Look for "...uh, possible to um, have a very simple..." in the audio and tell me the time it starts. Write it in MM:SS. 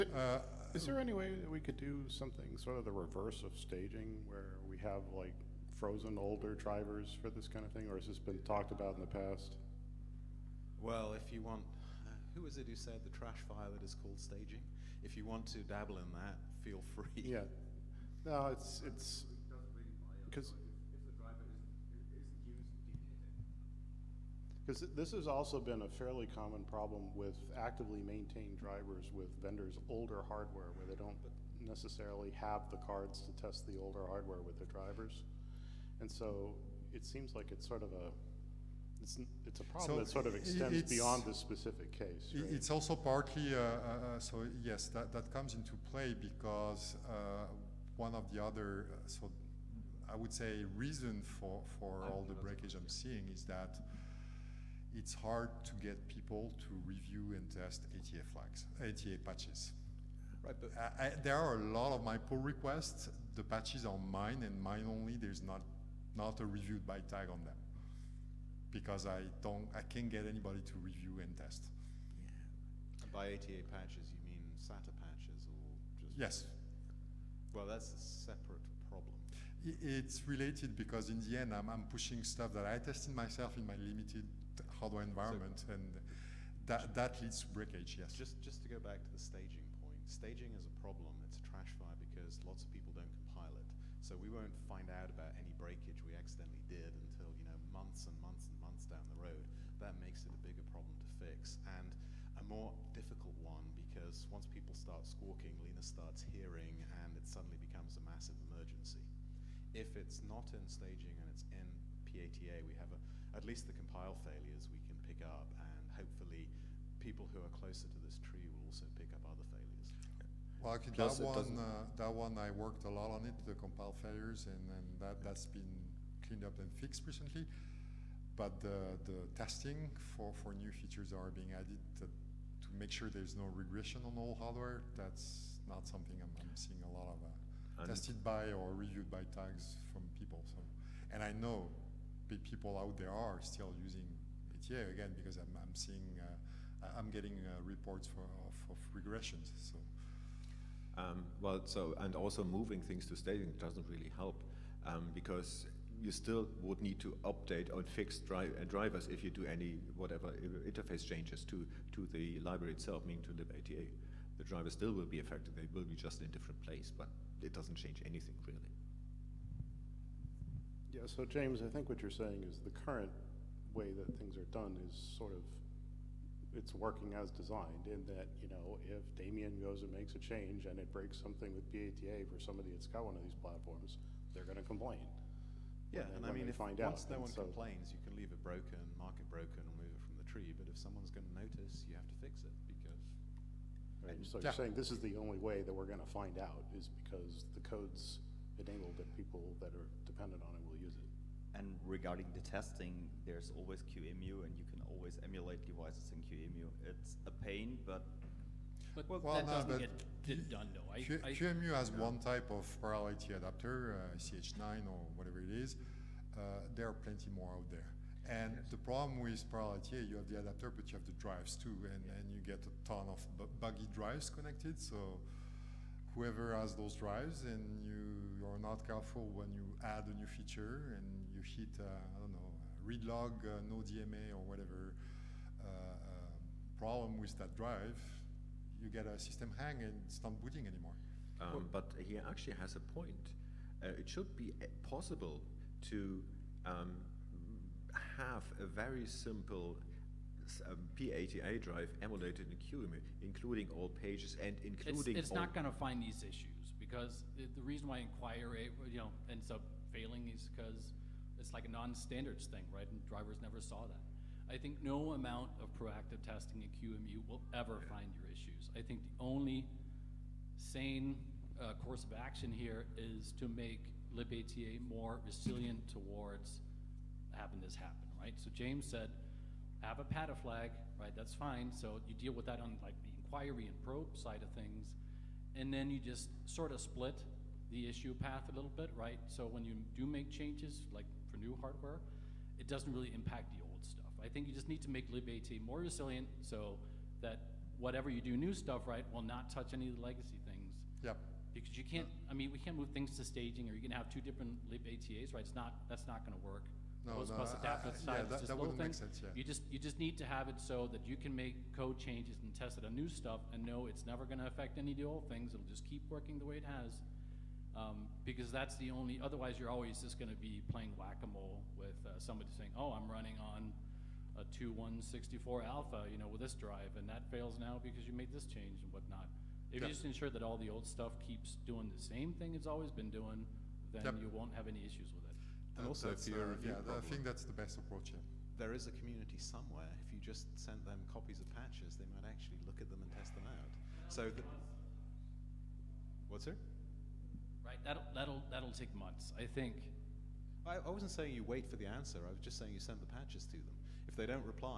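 04:04.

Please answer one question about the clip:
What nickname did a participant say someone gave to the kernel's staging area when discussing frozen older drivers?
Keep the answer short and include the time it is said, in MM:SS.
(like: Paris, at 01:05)
trash file, at 00:13.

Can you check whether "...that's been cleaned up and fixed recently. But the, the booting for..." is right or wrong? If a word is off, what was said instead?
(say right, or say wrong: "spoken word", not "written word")
wrong: "testing", not "booting".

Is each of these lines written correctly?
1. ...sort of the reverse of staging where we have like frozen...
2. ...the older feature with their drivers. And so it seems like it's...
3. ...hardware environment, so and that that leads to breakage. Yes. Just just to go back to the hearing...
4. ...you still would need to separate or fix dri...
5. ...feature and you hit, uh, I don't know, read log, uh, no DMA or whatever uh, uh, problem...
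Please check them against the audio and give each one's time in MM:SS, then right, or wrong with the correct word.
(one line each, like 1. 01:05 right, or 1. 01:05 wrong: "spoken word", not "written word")
1. 00:02 right
2. 00:33 wrong: "hardware", not "feature"
3. 01:24 wrong: "staging", not "hearing"
4. 02:36 wrong: "update", not "separate"
5. 03:50 right.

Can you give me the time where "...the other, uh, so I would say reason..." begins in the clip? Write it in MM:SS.
00:48.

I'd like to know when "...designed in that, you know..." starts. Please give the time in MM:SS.
02:57.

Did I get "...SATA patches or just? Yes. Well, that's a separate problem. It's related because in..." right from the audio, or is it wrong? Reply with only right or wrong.
right.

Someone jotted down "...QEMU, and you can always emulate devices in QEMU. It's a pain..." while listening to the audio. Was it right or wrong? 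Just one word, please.
right.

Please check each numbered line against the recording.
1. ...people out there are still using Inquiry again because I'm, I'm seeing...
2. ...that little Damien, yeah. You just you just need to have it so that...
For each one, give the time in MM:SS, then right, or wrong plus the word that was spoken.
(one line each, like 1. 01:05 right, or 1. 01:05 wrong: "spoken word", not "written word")
1. 02:22 wrong: "ATA", not "Inquiry"
2. 05:08 wrong: "Sense", not "Damien".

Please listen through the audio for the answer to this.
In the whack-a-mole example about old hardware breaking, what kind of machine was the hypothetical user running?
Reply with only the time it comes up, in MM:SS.
05:24.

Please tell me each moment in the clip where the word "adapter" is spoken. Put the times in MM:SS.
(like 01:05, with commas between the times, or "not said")
03:33, 03:40.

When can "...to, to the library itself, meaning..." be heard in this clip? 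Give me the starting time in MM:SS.
02:41.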